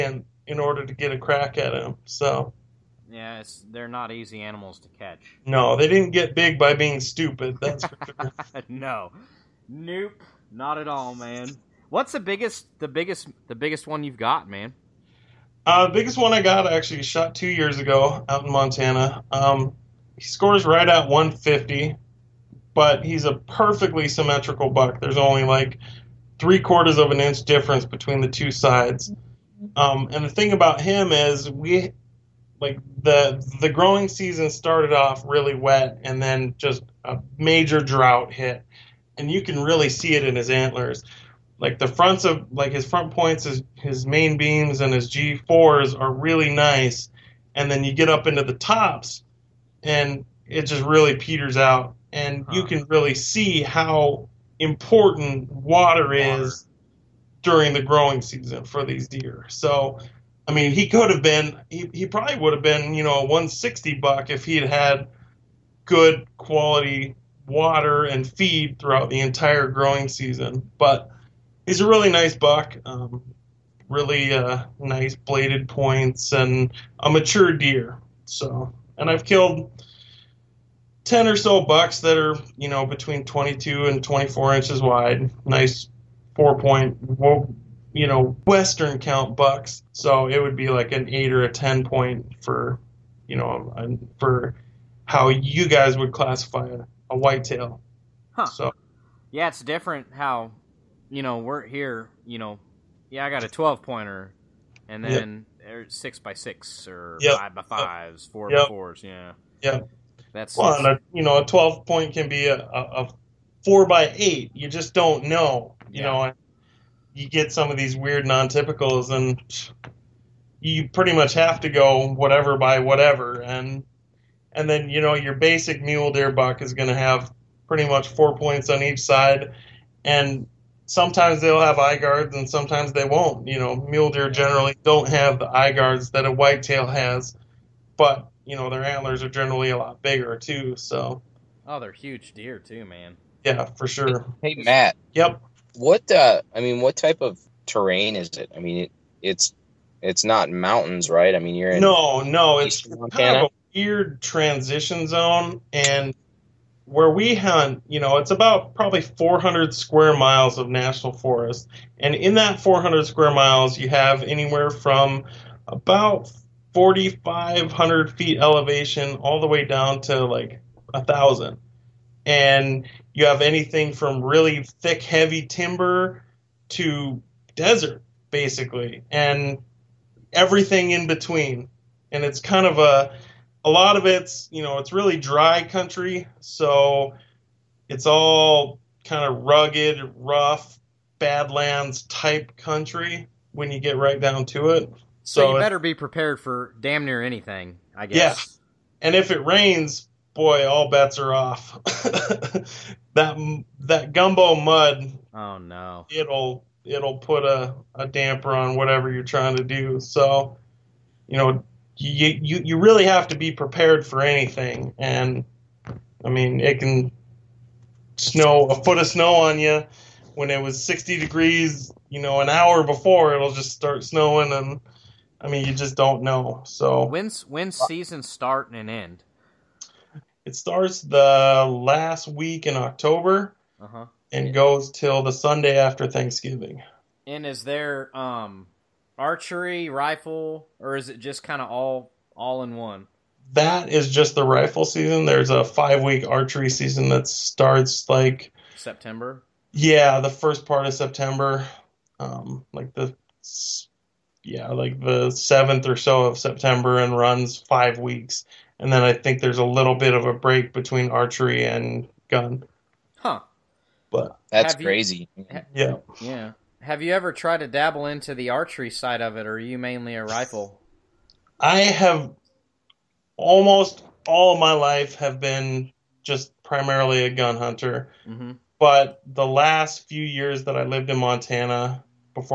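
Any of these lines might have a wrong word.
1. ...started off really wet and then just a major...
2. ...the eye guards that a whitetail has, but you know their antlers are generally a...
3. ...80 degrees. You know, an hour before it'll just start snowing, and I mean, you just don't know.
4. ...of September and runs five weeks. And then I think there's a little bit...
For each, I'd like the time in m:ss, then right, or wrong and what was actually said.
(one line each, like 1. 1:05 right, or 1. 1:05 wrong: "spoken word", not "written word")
1. 0:34 right
2. 2:15 right
3. 3:40 wrong: "60", not "80"
4. 4:16 right.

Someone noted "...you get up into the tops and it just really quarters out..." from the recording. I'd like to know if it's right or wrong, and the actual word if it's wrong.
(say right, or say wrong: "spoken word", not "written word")
wrong: "peters", not "quarters".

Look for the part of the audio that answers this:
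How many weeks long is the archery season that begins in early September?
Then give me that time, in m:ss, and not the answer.
4:05.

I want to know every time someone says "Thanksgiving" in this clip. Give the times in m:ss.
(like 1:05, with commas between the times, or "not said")
3:56.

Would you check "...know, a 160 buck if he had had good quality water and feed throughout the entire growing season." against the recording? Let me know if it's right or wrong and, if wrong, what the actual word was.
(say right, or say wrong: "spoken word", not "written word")
right.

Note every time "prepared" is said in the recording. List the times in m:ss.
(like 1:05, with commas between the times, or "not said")
3:15, 3:33.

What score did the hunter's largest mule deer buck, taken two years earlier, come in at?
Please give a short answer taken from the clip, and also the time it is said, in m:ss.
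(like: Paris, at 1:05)
150, at 0:21.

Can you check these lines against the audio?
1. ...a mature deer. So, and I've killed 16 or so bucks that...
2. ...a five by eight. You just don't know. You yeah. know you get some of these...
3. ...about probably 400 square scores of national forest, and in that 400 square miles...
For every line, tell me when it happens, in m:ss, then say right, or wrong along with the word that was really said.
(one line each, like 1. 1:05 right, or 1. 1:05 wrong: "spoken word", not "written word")
1. 1:16 wrong: "10", not "16"
2. 1:53 wrong: "four", not "five"
3. 2:38 wrong: "miles", not "scores".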